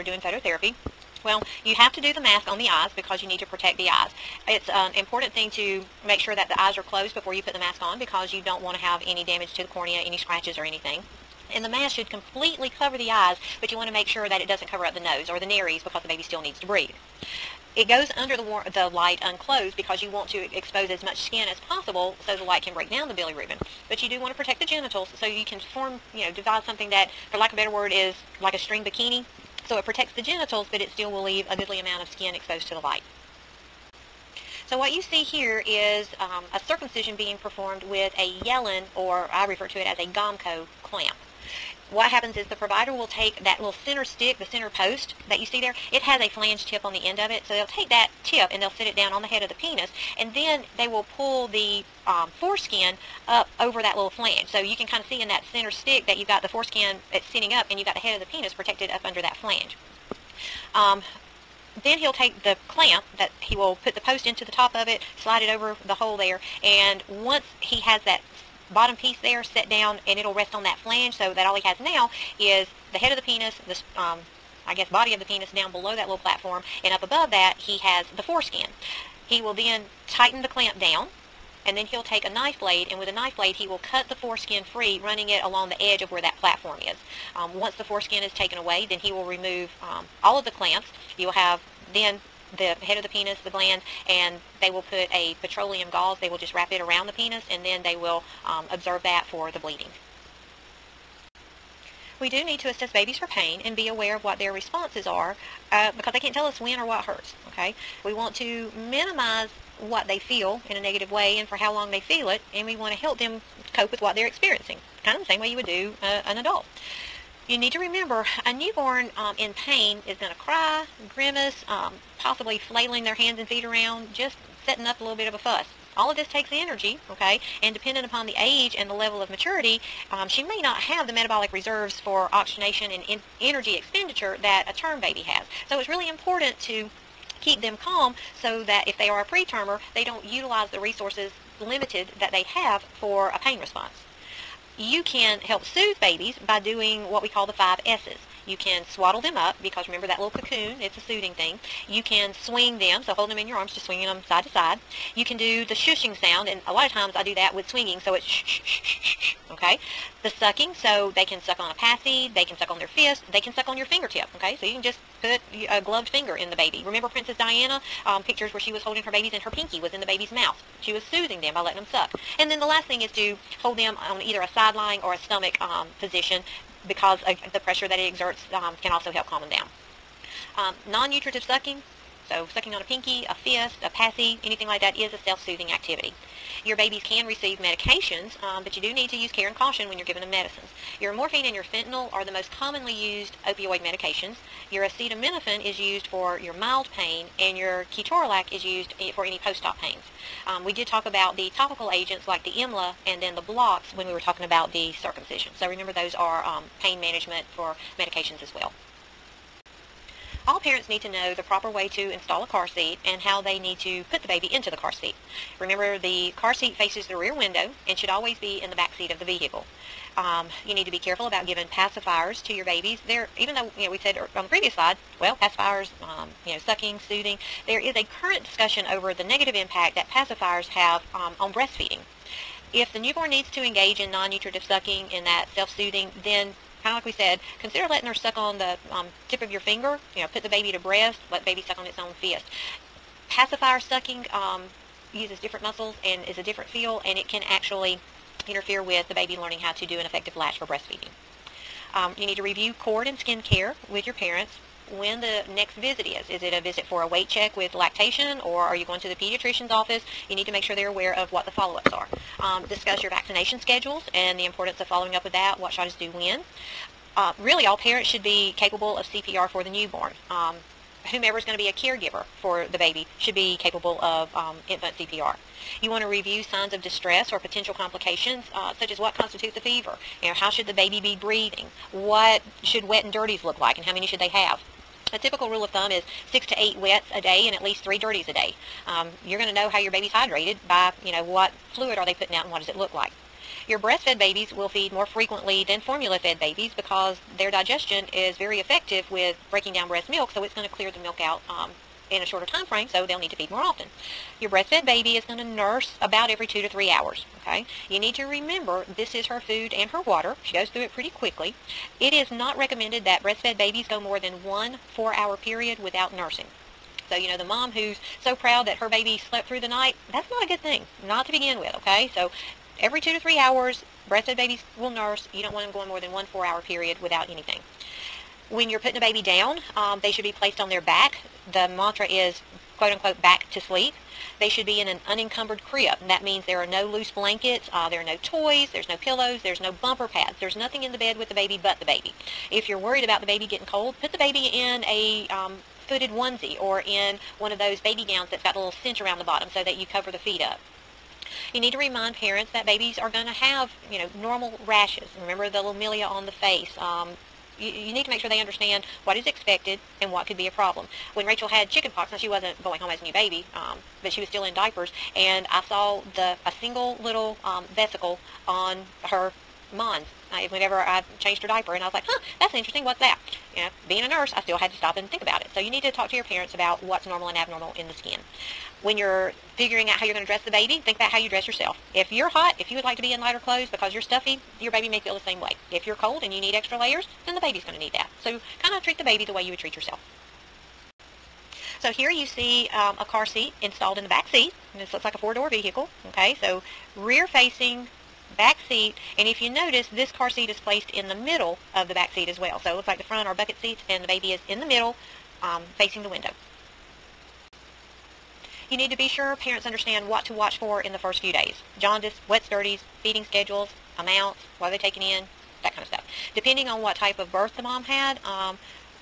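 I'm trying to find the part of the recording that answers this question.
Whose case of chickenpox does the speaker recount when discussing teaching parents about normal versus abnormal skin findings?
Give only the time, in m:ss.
6:01.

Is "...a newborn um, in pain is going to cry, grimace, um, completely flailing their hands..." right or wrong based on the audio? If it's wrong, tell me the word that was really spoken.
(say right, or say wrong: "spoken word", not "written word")
wrong: "possibly", not "completely".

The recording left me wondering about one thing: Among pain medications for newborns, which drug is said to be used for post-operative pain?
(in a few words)
ketorolac.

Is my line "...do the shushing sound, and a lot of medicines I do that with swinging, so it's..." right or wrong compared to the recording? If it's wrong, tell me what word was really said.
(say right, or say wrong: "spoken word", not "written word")
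wrong: "times", not "medicines".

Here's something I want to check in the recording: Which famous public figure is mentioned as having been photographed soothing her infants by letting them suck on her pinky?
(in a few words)
Princess Diana.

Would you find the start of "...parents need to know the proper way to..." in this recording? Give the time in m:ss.
3:30.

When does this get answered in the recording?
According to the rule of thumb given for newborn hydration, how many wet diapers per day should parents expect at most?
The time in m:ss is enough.
4:46.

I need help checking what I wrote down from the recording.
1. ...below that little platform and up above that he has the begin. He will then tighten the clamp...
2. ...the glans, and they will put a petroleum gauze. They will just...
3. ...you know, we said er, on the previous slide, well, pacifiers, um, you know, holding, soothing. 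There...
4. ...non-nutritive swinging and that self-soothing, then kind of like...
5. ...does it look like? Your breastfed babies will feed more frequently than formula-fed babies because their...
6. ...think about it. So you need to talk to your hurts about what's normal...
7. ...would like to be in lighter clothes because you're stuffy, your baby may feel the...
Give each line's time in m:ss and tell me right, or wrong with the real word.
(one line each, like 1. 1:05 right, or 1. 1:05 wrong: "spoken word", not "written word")
1. 1:15 wrong: "foreskin", not "begin"
2. 1:33 right
3. 3:43 wrong: "sucking", not "holding"
4. 3:54 wrong: "sucking", not "swinging"
5. 4:52 right
6. 6:15 wrong: "parents", not "hurts"
7. 6:22 right.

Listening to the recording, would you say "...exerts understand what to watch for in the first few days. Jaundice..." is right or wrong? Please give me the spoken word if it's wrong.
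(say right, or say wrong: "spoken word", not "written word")
wrong: "parents", not "exerts".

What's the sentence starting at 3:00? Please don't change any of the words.
Um, Non-nutritive sucking, so sucking on a pinky, a fist, a passy, anything like that is a self-soothing activity.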